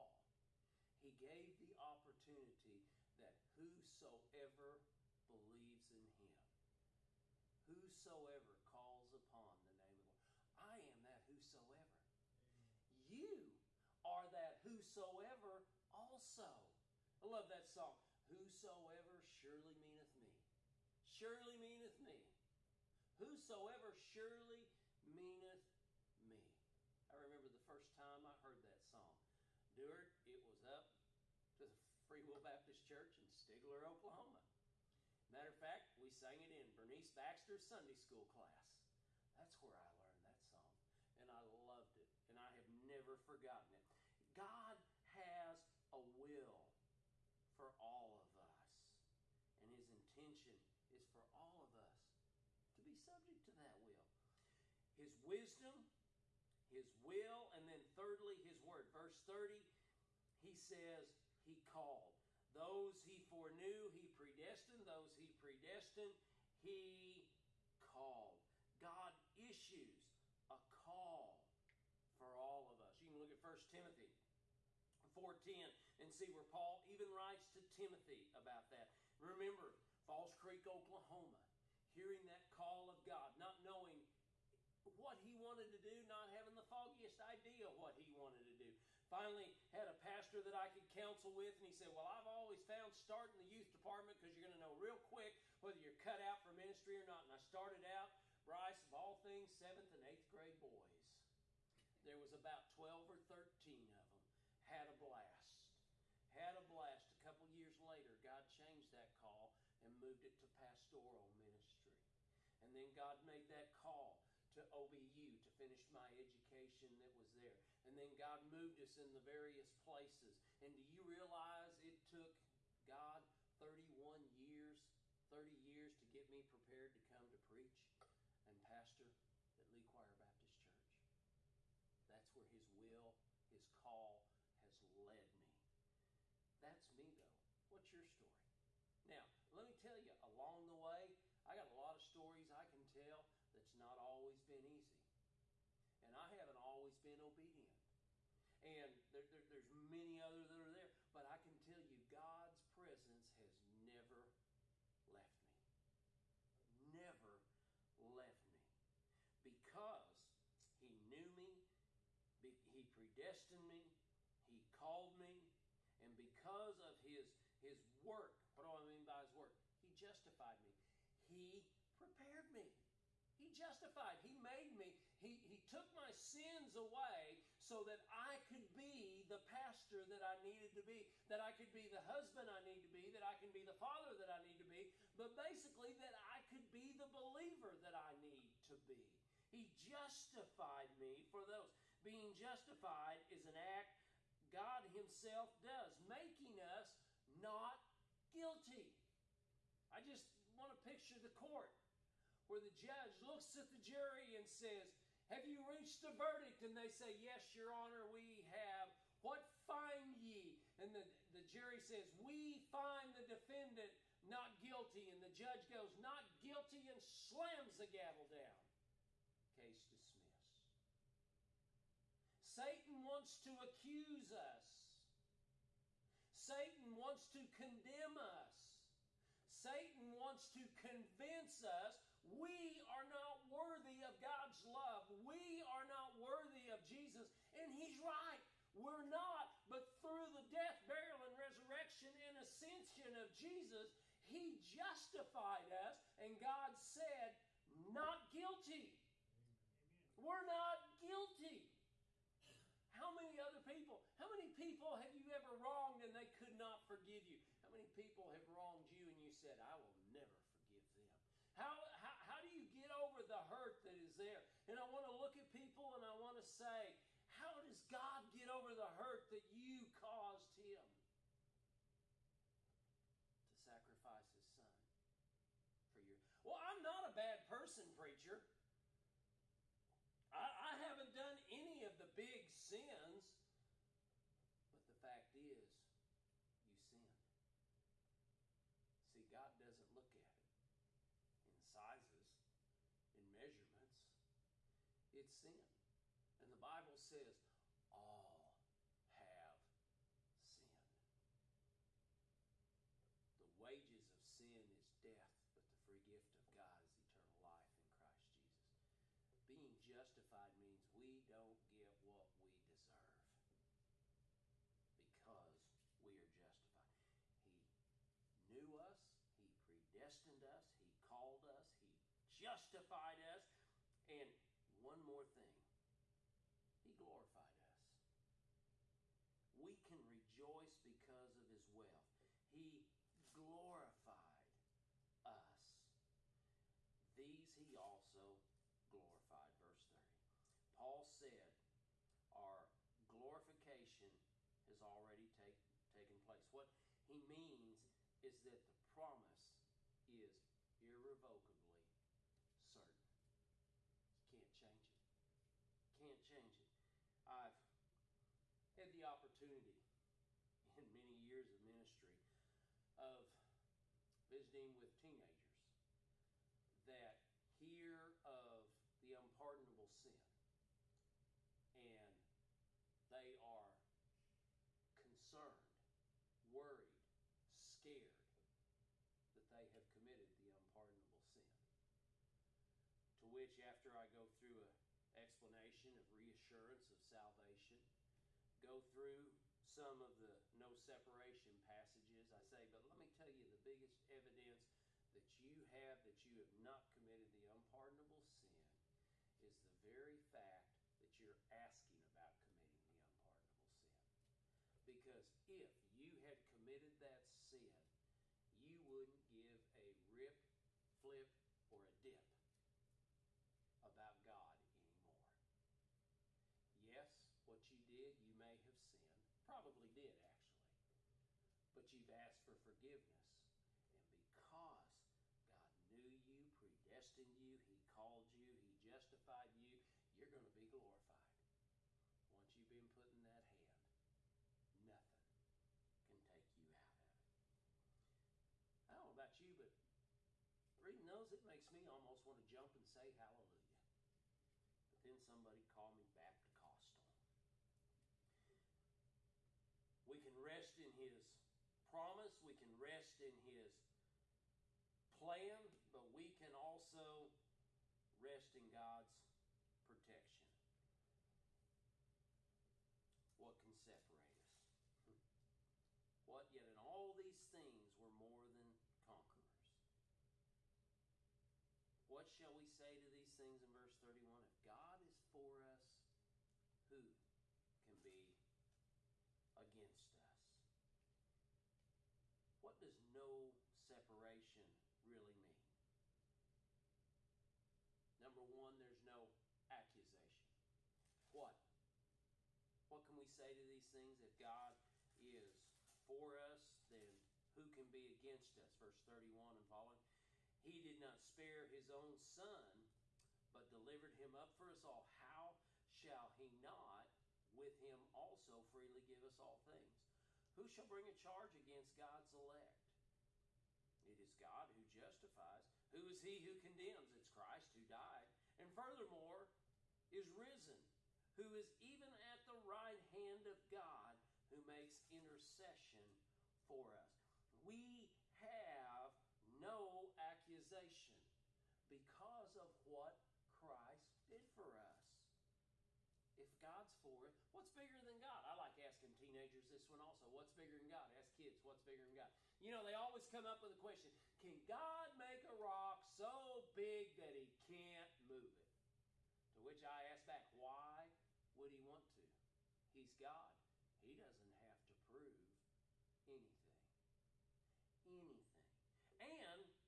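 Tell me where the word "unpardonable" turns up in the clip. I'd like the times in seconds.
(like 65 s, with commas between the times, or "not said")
369 s, 380 s, 397 s, 402 s.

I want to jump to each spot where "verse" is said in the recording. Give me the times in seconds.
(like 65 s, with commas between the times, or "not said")
58 s, 339 s, 473 s, 498 s.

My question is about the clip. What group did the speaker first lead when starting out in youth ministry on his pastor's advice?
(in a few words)
Seventh and eighth grade boys.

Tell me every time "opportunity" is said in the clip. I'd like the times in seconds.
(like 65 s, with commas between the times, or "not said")
1 s, 359 s.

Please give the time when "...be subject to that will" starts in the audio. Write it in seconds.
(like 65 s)
52 s.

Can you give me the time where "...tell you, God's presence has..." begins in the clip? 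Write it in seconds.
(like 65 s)
151 s.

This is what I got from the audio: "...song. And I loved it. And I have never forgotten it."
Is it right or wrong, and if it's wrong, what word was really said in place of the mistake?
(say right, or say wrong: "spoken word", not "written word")
right.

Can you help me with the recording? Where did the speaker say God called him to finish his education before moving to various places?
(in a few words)
OBU.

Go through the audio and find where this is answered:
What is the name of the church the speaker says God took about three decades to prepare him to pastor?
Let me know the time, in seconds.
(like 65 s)
129 s.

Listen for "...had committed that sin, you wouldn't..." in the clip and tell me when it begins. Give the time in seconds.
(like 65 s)
406 s.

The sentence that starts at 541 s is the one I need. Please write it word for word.
Ask kids, what's bigger than God?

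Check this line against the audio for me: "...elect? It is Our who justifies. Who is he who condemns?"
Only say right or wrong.
wrong.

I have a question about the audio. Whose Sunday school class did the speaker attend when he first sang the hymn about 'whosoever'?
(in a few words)
Bernice Baxter.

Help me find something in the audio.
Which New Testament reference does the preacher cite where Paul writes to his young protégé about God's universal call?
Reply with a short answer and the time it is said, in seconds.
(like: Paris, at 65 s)
1 Timothy 4:10, at 73 s.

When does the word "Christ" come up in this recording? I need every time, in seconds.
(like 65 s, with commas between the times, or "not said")
517 s, 533 s.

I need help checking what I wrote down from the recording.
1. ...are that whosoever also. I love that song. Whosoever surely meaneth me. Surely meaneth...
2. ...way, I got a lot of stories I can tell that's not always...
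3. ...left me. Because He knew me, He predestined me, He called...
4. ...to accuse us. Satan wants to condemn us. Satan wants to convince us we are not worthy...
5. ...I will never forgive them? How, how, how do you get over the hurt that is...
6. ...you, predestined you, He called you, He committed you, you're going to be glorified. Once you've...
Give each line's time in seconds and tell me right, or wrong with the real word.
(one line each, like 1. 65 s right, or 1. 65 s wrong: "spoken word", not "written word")
1. 14 s right
2. 140 s right
3. 157 s right
4. 223 s right
5. 259 s right
6. 426 s wrong: "justified", not "committed".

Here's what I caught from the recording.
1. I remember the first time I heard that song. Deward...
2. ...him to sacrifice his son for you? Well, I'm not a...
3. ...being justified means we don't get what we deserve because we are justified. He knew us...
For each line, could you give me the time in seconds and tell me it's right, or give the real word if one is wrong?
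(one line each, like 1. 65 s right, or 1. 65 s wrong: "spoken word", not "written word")
1. 27 s right
2. 270 s right
3. 309 s right.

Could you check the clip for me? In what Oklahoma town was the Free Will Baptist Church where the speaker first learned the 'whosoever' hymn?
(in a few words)
Stigler.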